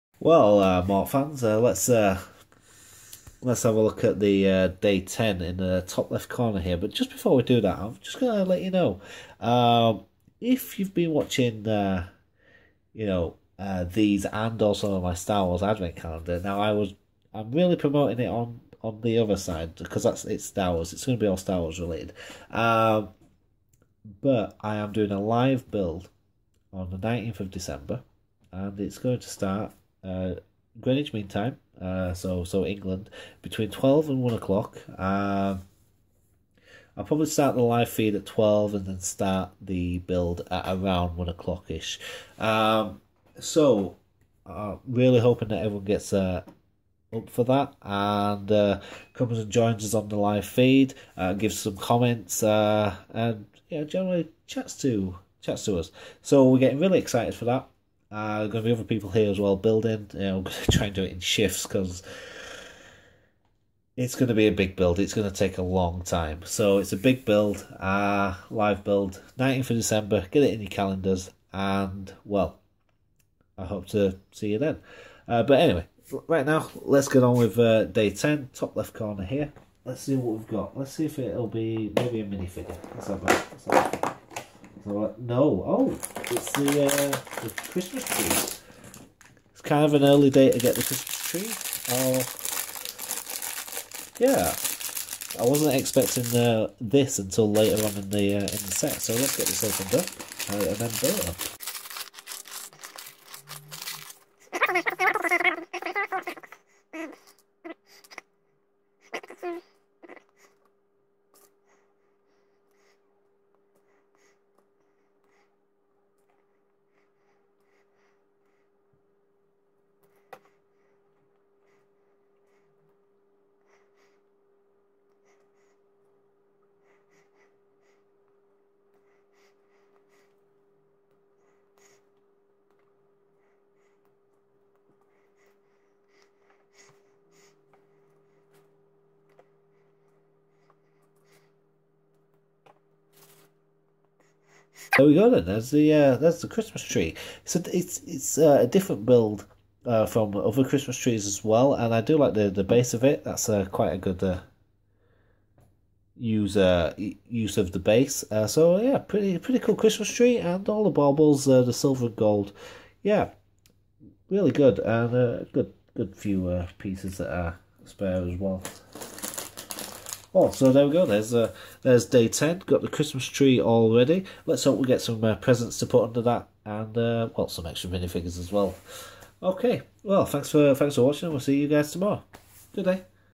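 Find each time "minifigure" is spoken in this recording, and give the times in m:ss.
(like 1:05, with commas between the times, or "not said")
1:22, 2:57.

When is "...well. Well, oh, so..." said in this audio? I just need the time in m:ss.
2:48.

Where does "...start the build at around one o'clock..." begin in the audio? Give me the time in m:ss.
0:38.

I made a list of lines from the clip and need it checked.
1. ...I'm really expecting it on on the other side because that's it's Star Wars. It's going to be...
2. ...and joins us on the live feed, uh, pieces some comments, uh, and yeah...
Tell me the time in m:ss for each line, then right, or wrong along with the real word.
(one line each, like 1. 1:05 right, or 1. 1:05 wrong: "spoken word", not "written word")
1. 0:17 wrong: "promoting", not "expecting"
2. 0:49 wrong: "gives", not "pieces".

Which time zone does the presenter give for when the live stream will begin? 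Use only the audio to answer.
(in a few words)
Greenwich Mean Time.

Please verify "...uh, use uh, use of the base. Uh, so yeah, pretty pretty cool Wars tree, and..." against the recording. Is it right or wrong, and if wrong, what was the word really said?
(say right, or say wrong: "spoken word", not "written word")
wrong: "Christmas", not "Wars".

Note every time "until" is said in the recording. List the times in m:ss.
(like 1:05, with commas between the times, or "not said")
1:37.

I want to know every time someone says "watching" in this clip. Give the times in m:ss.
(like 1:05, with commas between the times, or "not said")
0:11, 3:01.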